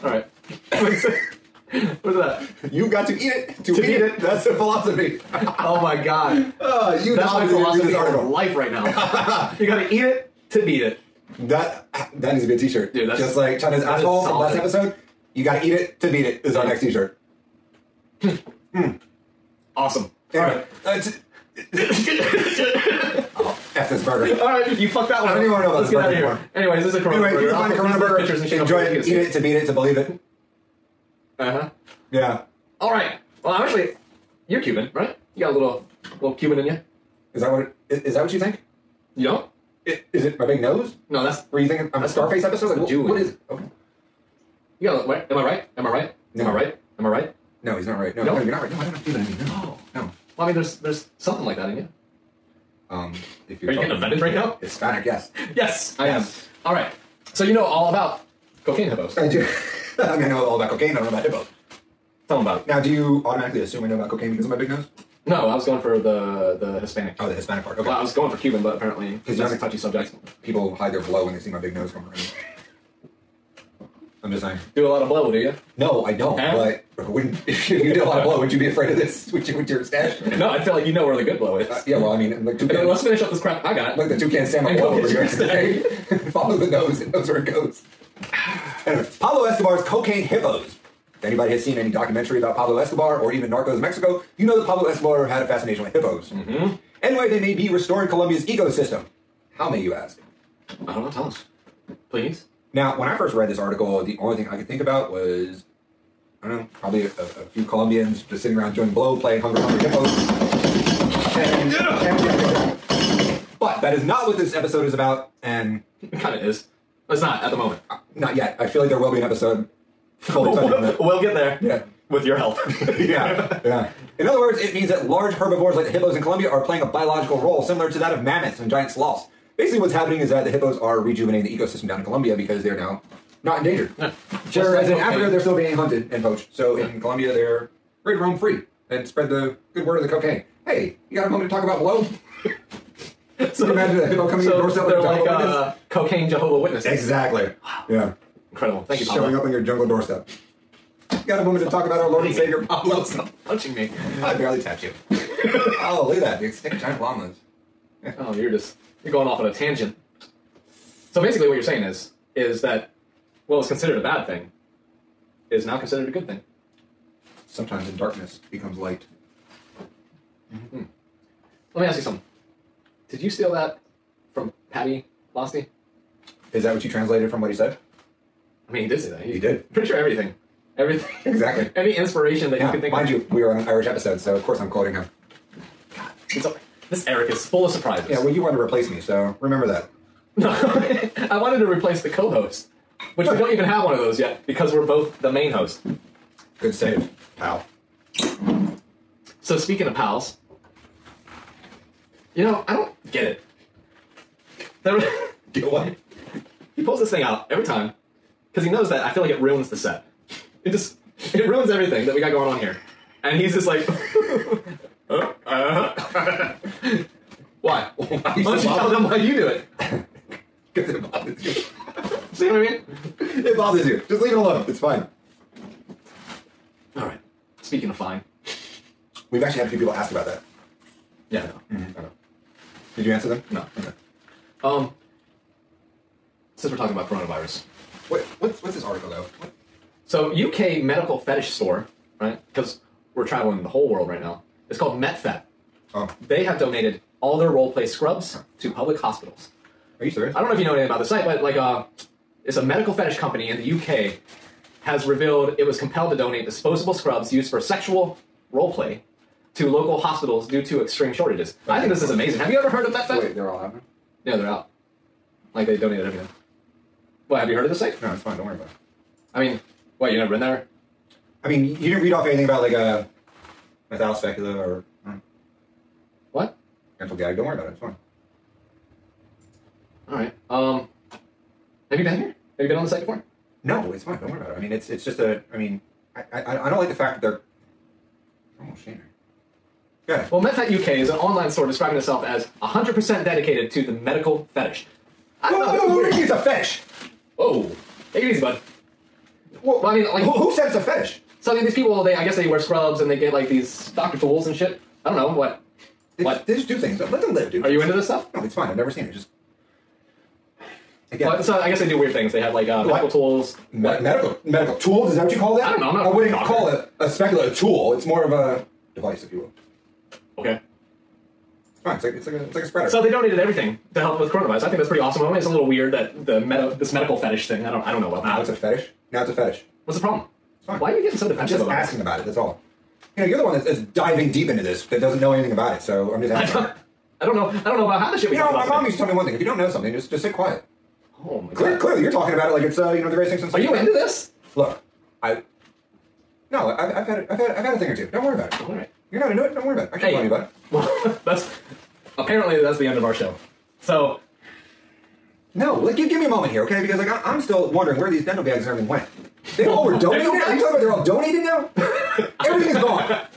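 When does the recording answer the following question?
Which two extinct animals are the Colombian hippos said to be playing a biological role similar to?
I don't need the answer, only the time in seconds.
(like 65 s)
128 s.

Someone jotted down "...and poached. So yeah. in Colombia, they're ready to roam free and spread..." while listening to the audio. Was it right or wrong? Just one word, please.
right.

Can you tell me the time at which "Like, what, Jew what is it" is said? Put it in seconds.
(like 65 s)
42 s.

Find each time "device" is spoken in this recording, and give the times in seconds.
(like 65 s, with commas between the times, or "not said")
318 s.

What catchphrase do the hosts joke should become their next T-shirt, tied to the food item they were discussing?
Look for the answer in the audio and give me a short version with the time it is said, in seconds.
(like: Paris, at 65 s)
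You gotta eat it to beat it, at 15 s.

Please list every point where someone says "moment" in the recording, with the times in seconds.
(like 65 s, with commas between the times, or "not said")
117 s, 141 s, 151 s, 356 s.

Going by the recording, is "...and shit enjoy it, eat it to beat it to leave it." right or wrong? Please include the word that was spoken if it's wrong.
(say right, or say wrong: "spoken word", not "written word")
wrong: "believe", not "leave".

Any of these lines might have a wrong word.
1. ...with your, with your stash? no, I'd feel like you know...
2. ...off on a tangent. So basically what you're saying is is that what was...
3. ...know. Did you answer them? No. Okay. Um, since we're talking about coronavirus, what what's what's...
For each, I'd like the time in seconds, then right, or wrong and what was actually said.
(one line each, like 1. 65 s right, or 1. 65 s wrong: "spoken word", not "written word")
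1. 79 s right
2. 159 s right
3. 232 s right.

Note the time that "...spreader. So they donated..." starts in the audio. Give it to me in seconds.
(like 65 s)
322 s.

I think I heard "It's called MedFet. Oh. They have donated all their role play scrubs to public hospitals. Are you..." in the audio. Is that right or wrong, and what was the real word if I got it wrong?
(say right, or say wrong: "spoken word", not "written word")
right.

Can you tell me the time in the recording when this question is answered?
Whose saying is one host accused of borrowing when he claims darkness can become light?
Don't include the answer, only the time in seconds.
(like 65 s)
174 s.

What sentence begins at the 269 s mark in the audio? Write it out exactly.
I mean, what, you never been there?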